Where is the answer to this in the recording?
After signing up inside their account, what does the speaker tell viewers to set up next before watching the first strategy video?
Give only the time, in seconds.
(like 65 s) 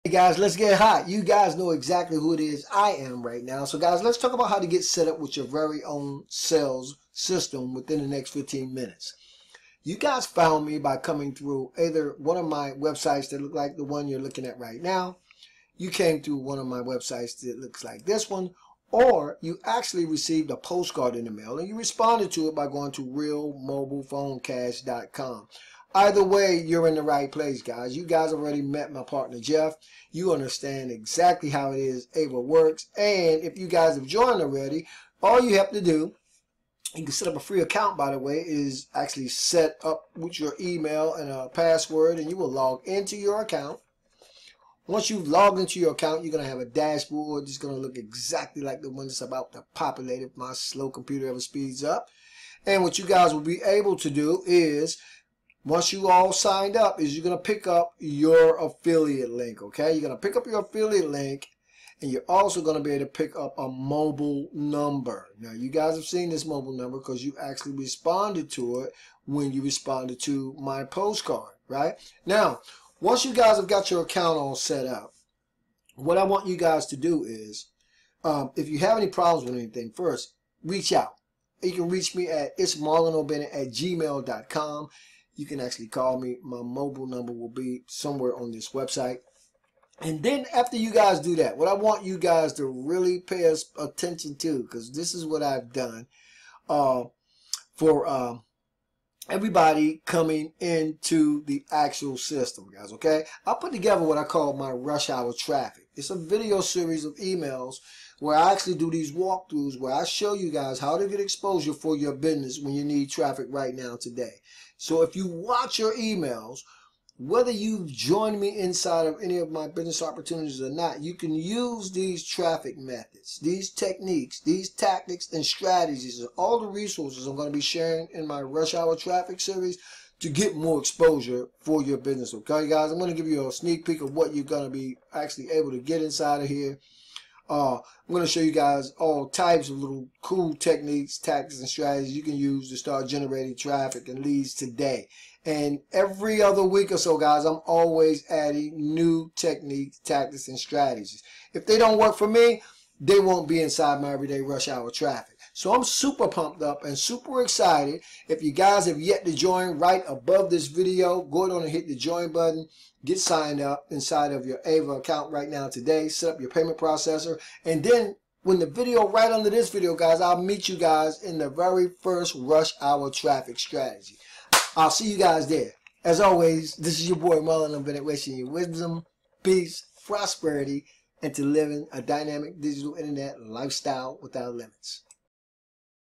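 166 s.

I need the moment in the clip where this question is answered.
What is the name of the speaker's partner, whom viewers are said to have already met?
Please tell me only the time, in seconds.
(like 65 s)
29 s.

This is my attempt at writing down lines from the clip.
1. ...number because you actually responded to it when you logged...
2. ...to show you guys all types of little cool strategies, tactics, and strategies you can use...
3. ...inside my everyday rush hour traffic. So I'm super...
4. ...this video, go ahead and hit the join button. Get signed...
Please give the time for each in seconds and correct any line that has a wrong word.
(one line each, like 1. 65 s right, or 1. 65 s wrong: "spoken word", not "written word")
1. 66 s wrong: "responded", not "logged"
2. 138 s wrong: "techniques", not "strategies"
3. 153 s right
4. 160 s right.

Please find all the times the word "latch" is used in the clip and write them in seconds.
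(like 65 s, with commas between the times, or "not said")
not said.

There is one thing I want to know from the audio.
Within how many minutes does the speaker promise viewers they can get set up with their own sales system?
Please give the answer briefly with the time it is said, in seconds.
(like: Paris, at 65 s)
15, at 8 s.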